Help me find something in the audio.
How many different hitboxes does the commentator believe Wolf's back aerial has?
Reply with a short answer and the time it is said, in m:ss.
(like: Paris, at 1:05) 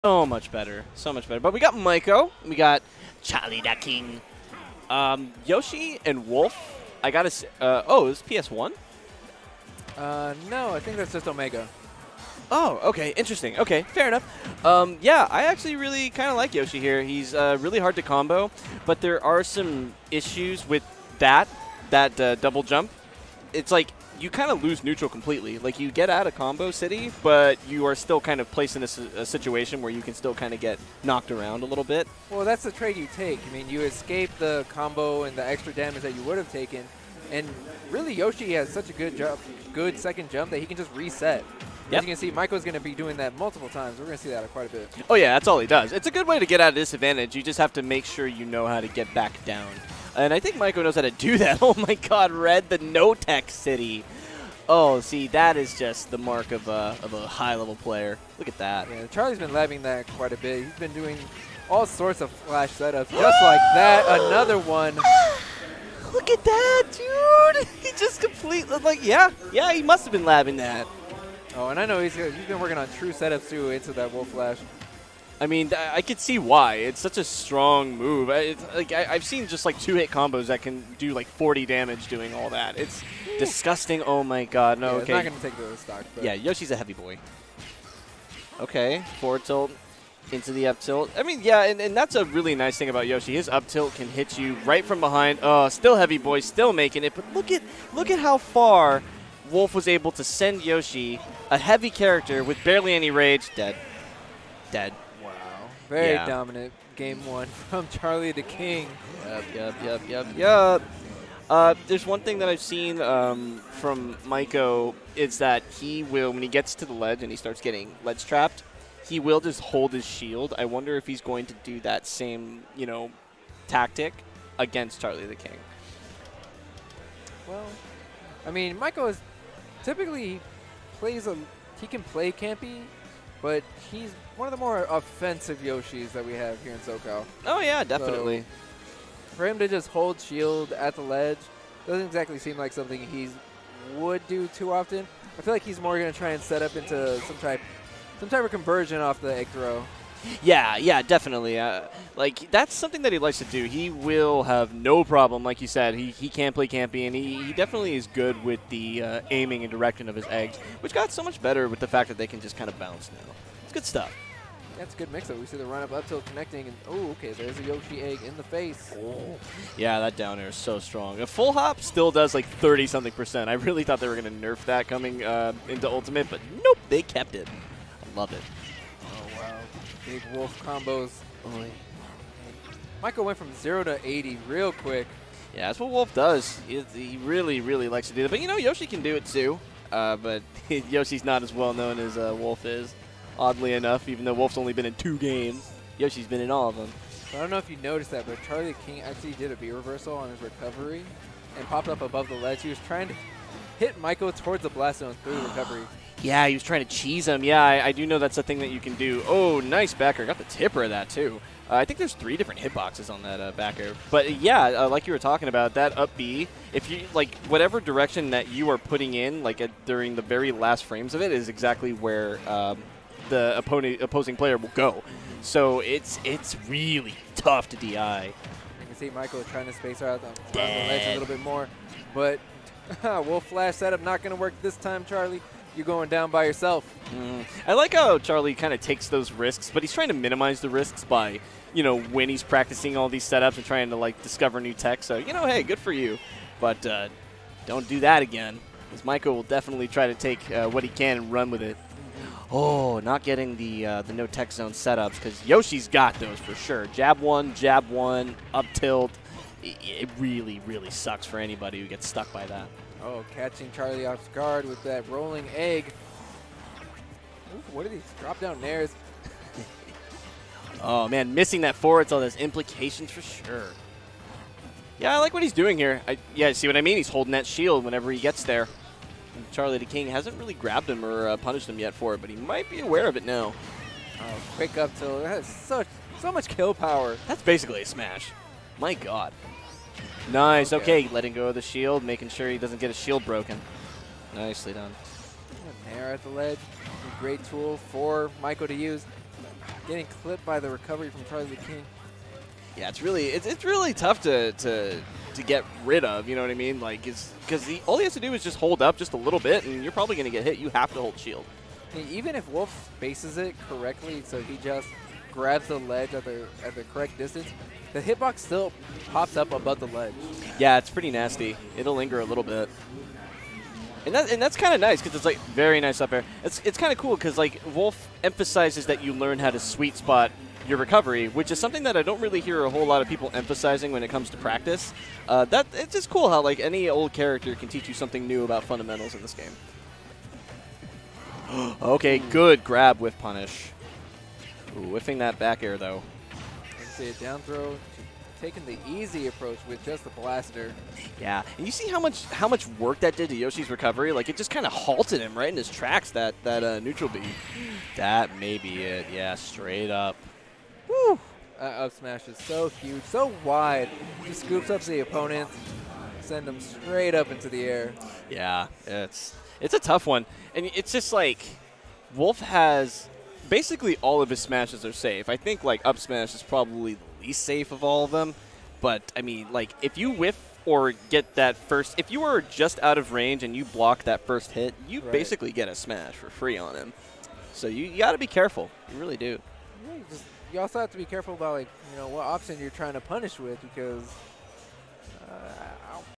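3, at 3:32.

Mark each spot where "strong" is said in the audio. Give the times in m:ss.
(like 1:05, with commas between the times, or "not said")
1:17, 2:50.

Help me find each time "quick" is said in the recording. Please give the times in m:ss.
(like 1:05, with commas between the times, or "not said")
3:04, 4:44.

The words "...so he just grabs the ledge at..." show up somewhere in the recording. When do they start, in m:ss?
5:14.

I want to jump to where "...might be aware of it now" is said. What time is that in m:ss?
4:42.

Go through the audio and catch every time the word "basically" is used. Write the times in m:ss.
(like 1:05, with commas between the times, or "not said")
4:47, 6:13, 6:25.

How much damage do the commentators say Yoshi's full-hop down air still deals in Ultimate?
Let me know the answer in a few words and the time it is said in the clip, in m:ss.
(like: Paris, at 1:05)
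30-something percent, at 2:52.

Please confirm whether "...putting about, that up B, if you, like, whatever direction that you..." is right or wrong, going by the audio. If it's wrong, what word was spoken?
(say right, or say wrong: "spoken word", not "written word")
wrong: "talking", not "putting".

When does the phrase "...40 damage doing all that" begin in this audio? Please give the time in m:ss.
1:21.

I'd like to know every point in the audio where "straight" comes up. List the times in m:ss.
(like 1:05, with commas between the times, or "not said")
5:59, 6:06.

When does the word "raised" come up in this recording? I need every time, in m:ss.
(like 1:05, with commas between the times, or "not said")
not said.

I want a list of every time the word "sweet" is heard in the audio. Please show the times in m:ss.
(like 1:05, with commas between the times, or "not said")
5:29.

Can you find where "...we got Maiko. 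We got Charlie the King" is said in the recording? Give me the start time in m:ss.
0:01.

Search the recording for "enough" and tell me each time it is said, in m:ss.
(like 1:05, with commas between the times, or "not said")
0:14, 3:13.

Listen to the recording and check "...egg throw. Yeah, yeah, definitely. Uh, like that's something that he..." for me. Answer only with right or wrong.
right.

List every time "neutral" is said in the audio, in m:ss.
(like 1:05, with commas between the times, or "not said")
0:24, 5:56.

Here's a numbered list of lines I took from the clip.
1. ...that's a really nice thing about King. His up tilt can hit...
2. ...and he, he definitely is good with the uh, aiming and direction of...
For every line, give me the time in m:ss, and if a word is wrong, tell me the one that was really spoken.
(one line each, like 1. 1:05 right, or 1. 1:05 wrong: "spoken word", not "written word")
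1. 1:31 wrong: "Yoshi", not "King"
2. 2:37 right.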